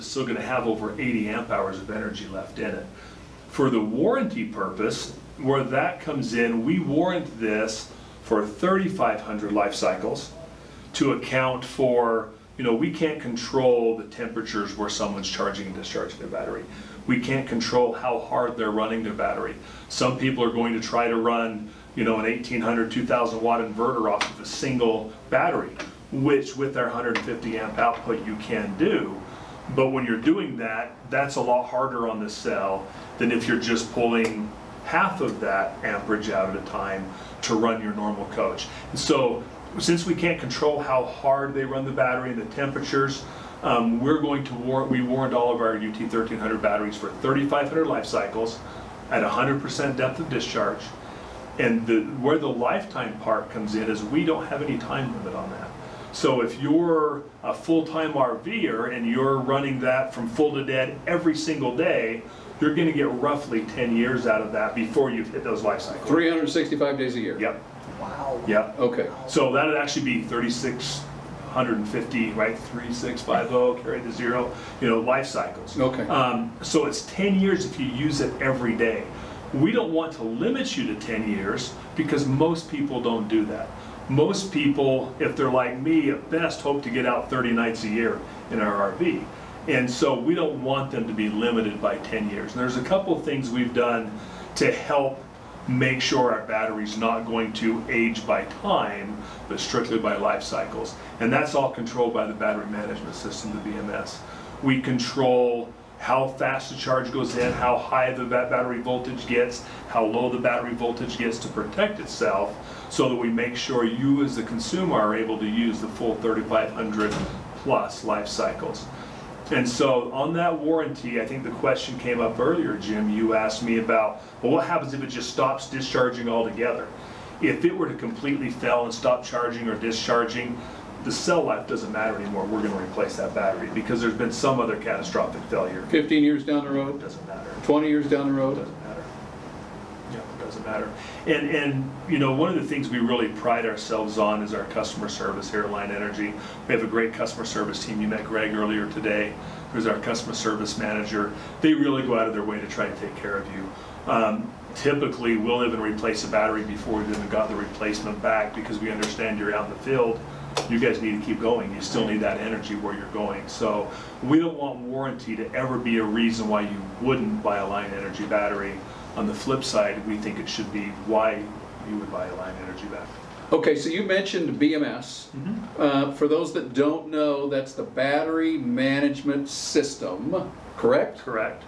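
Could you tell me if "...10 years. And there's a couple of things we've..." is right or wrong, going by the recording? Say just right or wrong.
right.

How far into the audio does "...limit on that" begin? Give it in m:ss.
0:55.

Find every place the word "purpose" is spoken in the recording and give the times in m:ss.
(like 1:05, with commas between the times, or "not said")
0:04.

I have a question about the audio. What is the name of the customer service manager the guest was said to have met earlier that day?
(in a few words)
Greg.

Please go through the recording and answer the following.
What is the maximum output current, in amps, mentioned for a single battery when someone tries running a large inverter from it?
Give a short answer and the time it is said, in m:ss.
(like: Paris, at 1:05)
150 amps, at 0:26.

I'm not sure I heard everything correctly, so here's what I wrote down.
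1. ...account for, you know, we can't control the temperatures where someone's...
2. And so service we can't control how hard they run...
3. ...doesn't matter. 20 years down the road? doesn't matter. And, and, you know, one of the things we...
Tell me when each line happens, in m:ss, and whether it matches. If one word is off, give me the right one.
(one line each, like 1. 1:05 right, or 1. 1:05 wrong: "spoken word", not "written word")
1. 0:11 right
2. 0:38 wrong: "since", not "service"
3. 2:17 right.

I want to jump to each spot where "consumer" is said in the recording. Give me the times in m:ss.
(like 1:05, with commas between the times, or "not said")
1:54.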